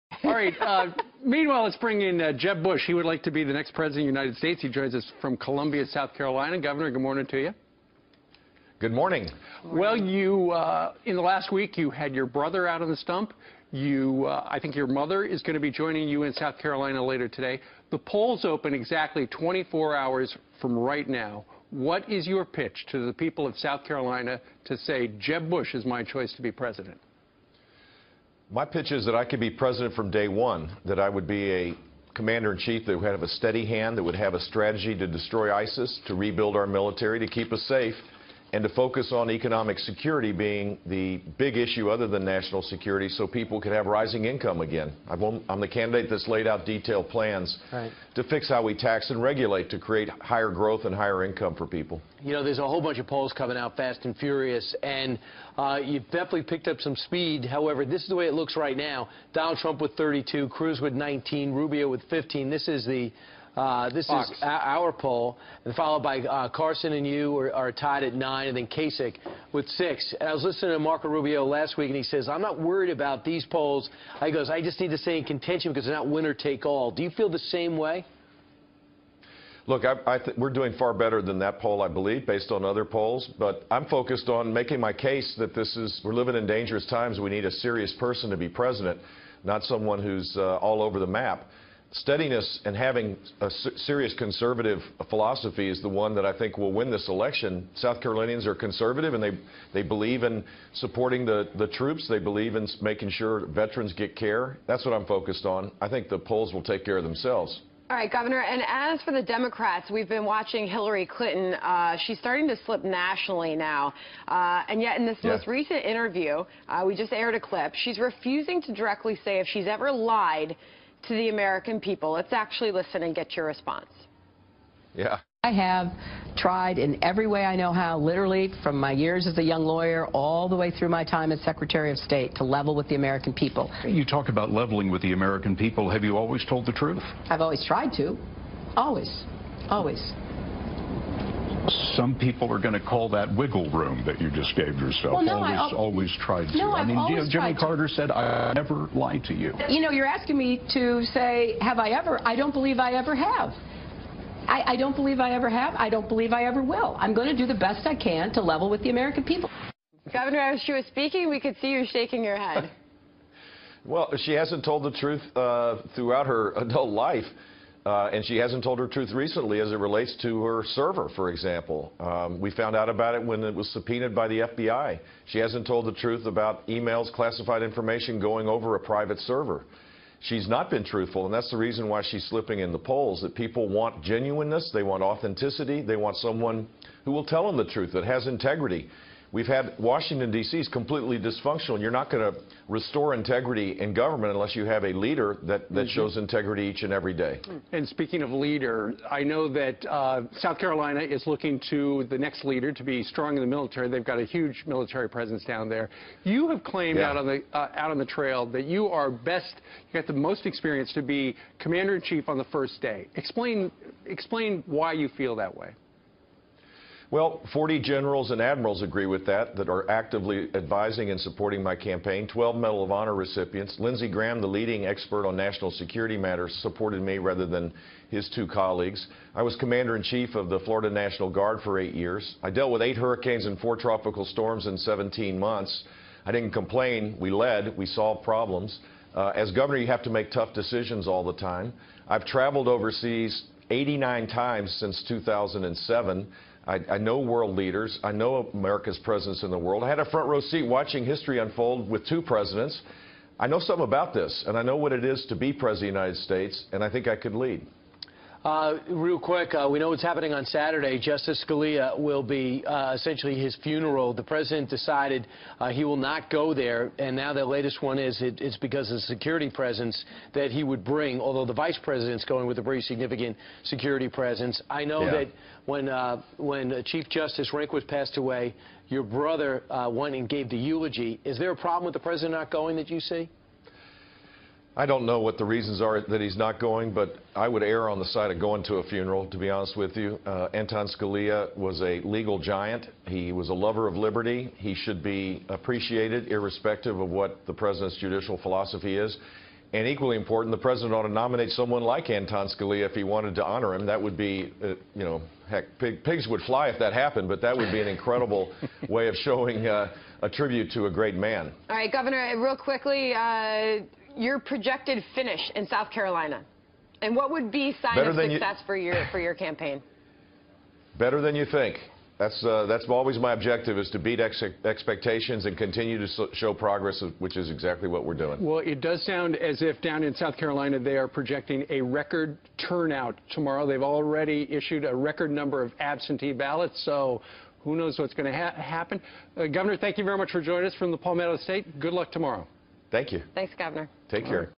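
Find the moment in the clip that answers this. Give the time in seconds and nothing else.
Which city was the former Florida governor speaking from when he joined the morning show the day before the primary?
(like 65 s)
5 s.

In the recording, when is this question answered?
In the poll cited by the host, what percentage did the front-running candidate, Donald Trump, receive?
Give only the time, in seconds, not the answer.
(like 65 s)
59 s.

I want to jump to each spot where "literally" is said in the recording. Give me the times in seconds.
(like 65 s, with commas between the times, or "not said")
127 s.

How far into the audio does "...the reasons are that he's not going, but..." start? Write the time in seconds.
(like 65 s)
285 s.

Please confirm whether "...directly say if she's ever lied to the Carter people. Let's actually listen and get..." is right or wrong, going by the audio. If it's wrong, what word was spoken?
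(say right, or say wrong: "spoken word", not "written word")
wrong: "American", not "Carter".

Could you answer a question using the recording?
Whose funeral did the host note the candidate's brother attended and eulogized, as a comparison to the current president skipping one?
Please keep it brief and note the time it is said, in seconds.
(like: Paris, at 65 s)
Chief Justice Rehnquist, at 276 s.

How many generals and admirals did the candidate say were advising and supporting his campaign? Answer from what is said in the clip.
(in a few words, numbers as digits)
40.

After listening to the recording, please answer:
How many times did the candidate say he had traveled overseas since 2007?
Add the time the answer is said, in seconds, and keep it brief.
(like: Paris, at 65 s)
89, at 243 s.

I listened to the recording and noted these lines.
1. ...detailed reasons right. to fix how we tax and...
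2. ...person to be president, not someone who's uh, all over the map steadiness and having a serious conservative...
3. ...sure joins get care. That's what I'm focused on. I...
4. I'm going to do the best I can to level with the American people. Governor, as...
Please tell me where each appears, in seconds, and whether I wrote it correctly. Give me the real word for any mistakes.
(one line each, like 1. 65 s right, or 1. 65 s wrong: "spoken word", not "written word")
1. 46 s wrong: "plans", not "reasons"
2. 87 s right
3. 103 s wrong: "veterans", not "joins"
4. 156 s right.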